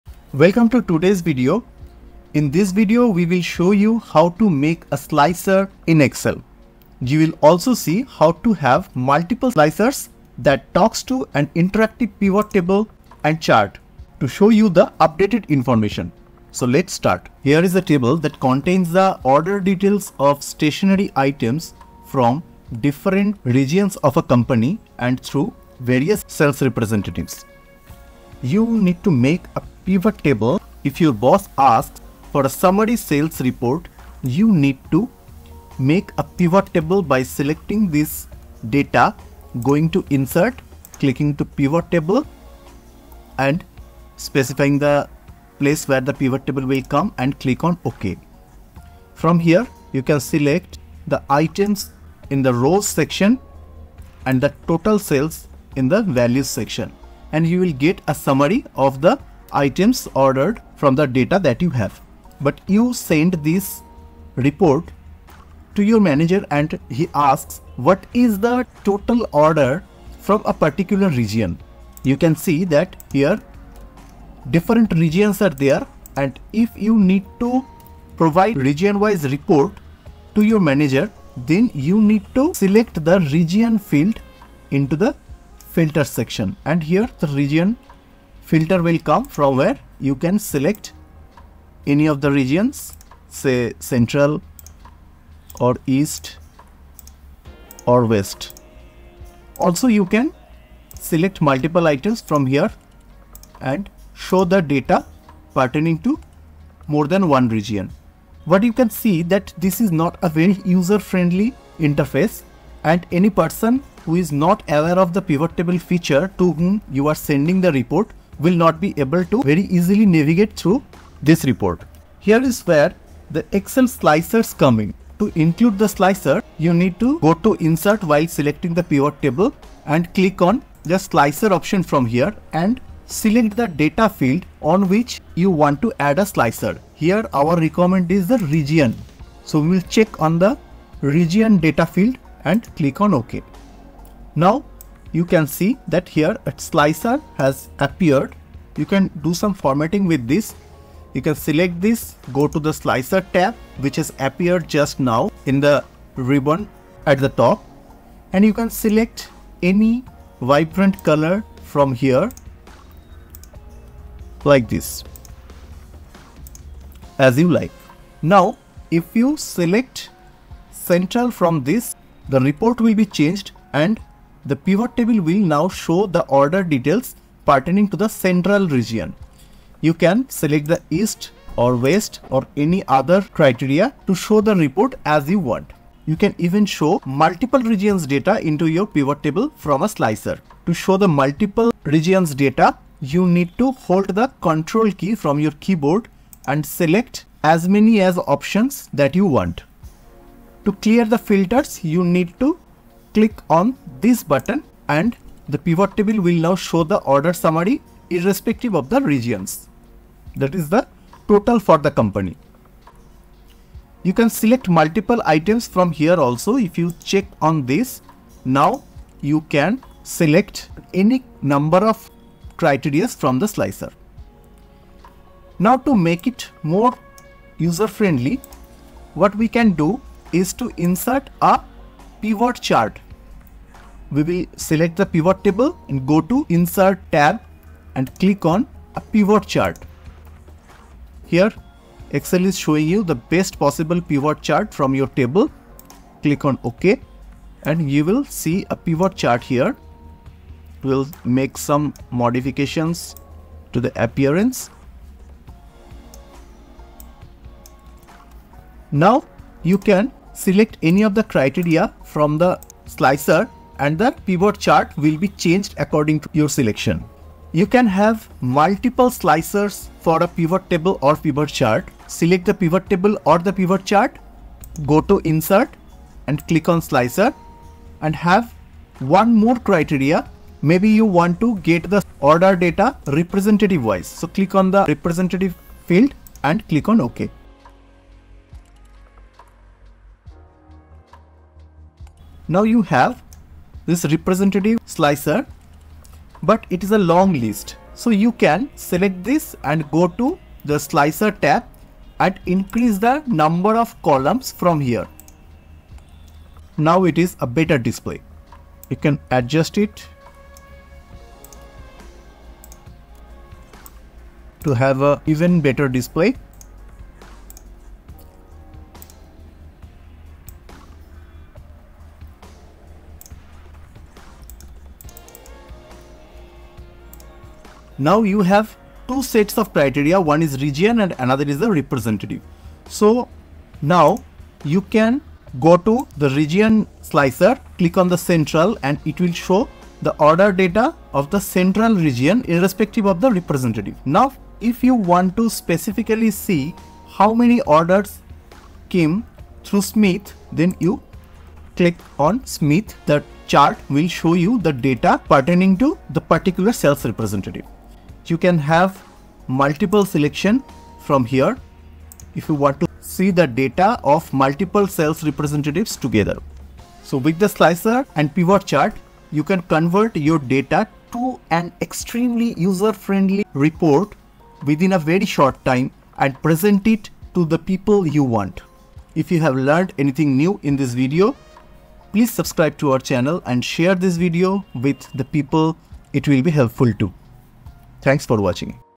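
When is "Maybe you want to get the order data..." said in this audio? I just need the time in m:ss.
4:40.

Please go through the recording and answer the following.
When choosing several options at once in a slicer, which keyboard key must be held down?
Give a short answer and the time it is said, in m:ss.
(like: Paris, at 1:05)
Control, at 3:14.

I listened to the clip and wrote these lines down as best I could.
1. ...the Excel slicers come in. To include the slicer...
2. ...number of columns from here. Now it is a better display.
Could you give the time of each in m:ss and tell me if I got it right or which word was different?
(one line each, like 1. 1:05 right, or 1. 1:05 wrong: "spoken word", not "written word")
1. 2:03 right
2. 5:03 right.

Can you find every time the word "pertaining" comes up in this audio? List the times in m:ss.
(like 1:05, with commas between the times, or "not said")
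1:45, 2:57, 5:55.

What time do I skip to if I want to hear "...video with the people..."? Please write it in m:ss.
6:24.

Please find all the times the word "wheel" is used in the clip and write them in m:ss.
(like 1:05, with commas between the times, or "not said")
not said.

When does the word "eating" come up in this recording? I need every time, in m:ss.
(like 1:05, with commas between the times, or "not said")
not said.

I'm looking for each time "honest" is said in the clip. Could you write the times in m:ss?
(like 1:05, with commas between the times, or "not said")
not said.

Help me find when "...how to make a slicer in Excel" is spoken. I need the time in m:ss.
0:03.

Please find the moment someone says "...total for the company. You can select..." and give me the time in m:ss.
3:31.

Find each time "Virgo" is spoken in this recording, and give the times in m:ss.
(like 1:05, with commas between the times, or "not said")
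not said.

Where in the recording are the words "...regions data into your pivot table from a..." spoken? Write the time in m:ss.
3:07.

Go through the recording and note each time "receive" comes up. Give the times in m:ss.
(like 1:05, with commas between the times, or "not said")
not said.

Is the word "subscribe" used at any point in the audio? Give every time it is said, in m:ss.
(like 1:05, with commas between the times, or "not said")
6:22.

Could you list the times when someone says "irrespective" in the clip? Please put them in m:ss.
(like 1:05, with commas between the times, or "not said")
3:28, 5:42.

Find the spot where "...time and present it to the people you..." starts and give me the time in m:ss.
6:15.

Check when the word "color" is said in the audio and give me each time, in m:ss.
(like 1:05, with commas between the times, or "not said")
2:41.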